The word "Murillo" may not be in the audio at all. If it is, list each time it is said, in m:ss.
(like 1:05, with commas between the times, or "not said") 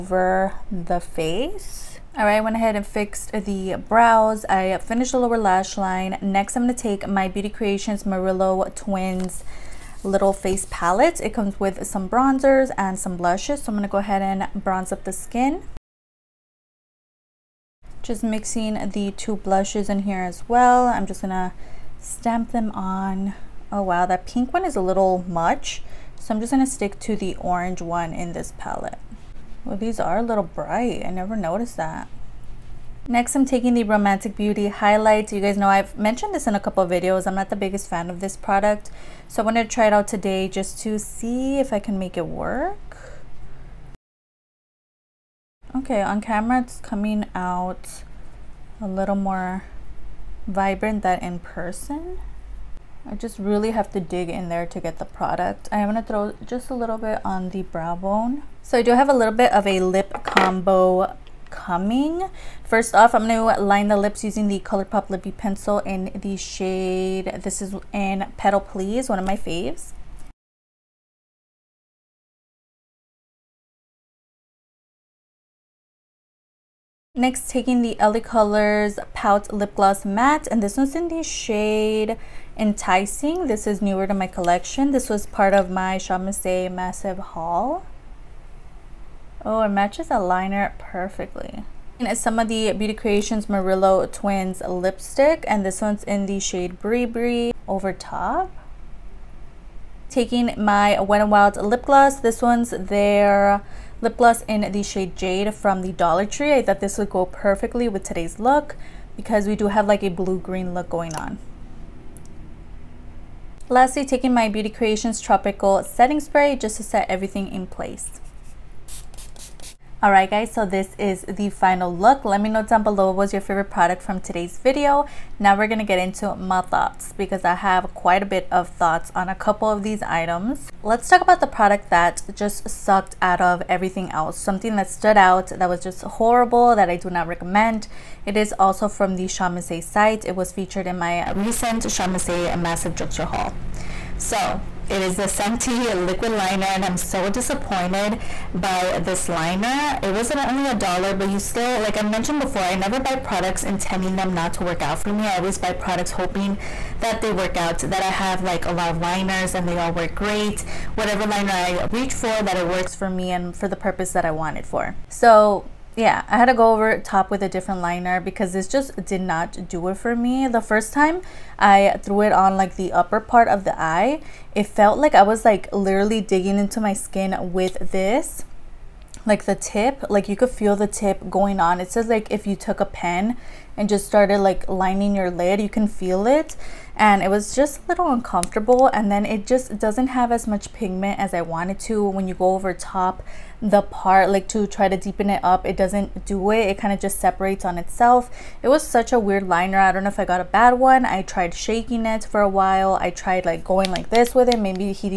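0:08, 1:33.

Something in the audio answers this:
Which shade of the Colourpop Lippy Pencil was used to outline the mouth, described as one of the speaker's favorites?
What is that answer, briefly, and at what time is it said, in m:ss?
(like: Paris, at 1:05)
Petal Please, at 1:08.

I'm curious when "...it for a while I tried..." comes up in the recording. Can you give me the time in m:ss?
3:22.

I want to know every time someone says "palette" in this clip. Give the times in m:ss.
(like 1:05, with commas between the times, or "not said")
0:10, 0:28.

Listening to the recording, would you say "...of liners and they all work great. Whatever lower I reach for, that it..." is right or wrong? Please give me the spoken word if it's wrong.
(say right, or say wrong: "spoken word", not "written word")
wrong: "liner", not "lower".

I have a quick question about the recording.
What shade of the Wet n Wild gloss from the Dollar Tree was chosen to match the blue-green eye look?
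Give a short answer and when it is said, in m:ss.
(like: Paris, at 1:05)
Jade, at 1:45.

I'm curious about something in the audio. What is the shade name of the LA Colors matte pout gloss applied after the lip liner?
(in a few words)
enticing.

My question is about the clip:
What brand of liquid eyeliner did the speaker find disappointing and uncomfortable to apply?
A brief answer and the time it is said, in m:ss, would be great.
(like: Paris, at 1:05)
Santee, at 2:25.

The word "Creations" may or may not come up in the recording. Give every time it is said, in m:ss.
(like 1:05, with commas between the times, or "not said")
0:07, 1:32, 1:54.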